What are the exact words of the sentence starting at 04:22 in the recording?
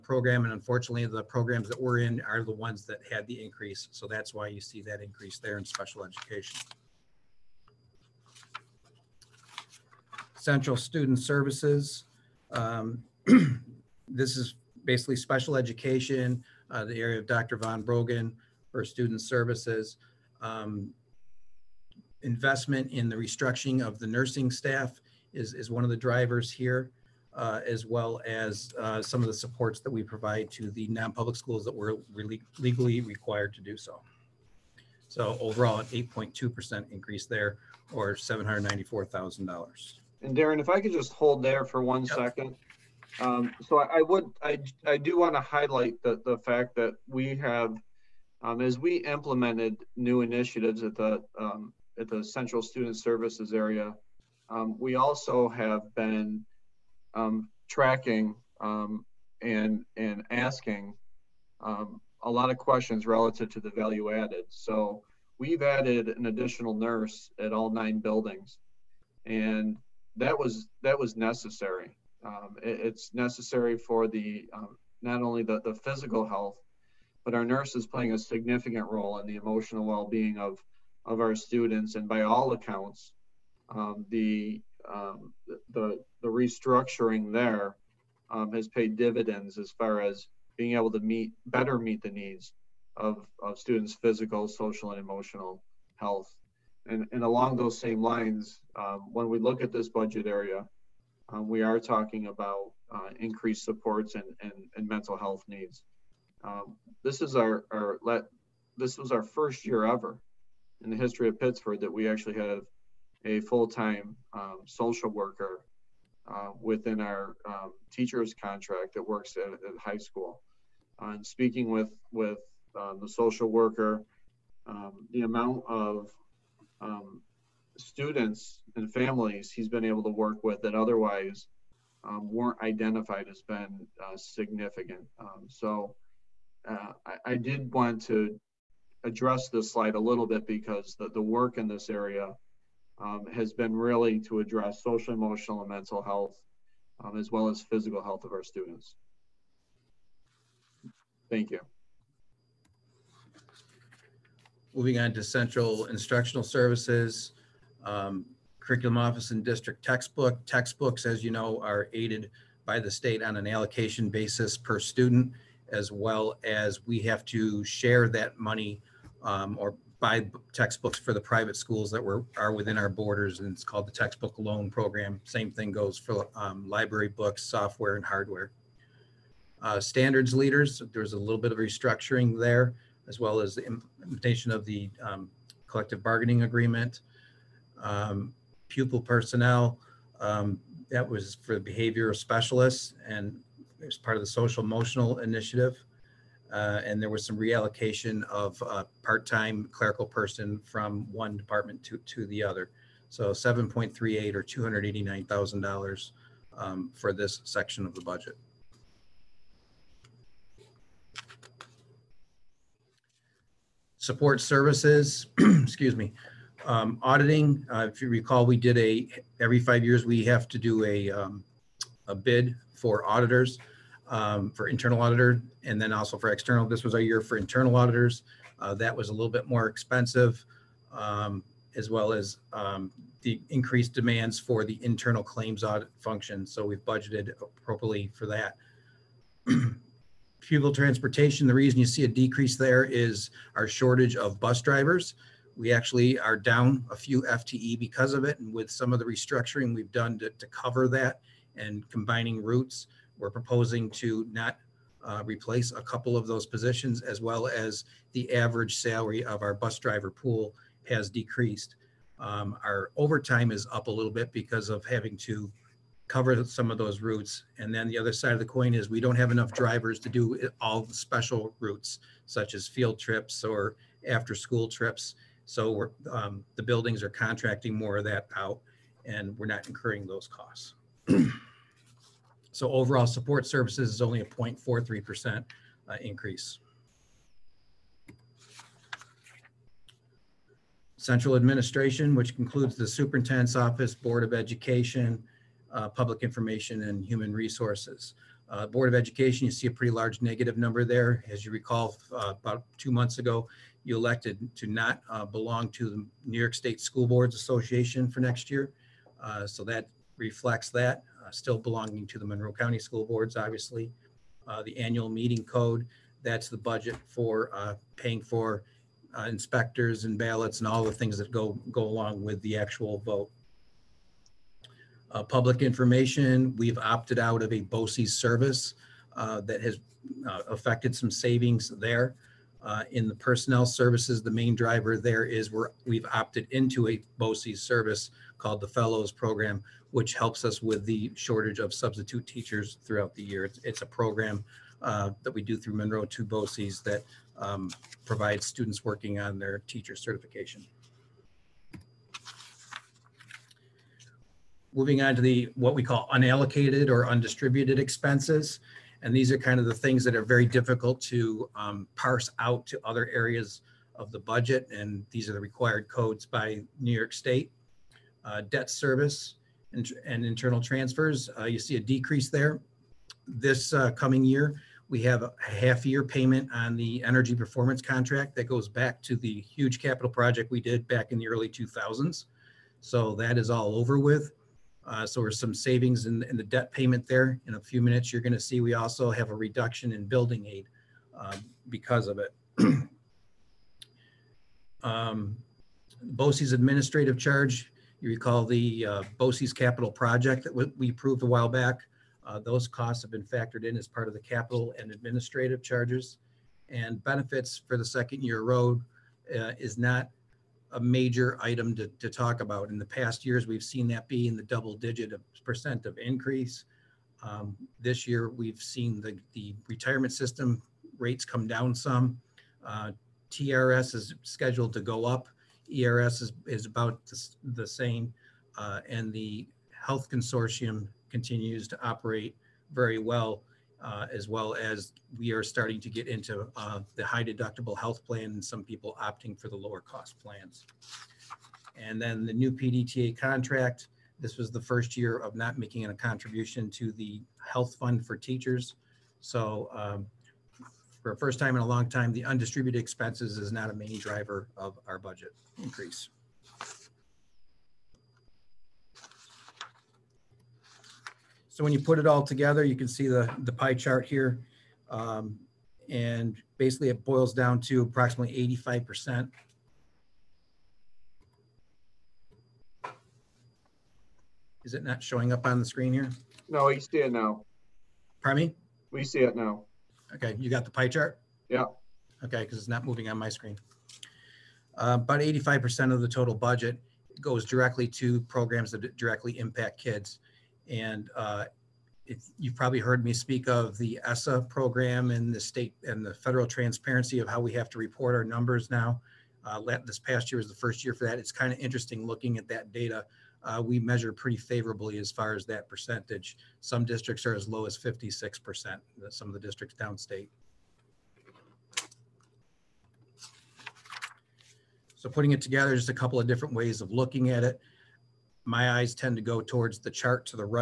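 Um, our overtime is up a little bit because of having to cover some of those routes.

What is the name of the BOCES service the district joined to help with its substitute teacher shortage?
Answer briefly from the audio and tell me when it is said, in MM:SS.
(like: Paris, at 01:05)
Fellows Program, at 05:38.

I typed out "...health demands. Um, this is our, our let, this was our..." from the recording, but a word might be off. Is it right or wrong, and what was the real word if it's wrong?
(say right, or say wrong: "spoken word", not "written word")
wrong: "needs", not "demands".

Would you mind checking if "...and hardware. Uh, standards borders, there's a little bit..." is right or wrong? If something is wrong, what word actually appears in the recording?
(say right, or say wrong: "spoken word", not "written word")
wrong: "leaders", not "borders".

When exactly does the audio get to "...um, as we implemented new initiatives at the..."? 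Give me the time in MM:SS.
00:48.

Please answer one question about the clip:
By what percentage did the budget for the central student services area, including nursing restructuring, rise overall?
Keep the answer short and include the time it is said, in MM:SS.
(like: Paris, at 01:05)
8.2%, at 00:35.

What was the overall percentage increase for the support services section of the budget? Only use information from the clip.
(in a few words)
0.43%.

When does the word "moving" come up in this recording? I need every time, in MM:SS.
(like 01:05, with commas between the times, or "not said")
02:34, 05:54, 08:02.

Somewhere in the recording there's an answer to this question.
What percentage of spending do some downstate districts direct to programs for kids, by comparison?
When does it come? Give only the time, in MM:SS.
08:27.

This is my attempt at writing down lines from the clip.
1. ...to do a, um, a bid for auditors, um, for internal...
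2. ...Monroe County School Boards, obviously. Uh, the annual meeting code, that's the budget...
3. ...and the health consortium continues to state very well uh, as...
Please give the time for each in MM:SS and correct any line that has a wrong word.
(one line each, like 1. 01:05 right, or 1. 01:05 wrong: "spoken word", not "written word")
1. 03:40 right
2. 05:12 right
3. 07:08 wrong: "operate", not "state".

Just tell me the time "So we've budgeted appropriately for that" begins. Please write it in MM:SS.
03:56.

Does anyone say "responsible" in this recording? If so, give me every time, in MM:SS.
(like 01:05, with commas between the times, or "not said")
not said.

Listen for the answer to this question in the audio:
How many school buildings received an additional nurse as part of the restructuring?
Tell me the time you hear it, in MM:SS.
01:07.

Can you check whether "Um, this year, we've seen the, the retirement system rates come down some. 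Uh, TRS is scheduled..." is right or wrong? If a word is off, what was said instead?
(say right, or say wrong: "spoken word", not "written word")
right.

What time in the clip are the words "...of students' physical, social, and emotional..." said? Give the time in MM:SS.
01:33.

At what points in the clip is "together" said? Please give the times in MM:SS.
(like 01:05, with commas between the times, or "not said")
07:42, 08:35.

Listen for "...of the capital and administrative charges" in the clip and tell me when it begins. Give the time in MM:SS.
06:44.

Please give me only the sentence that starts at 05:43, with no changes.
It's, it's a program uh, that we do through Monroe to BOCES that um, provides students working on their teacher certification.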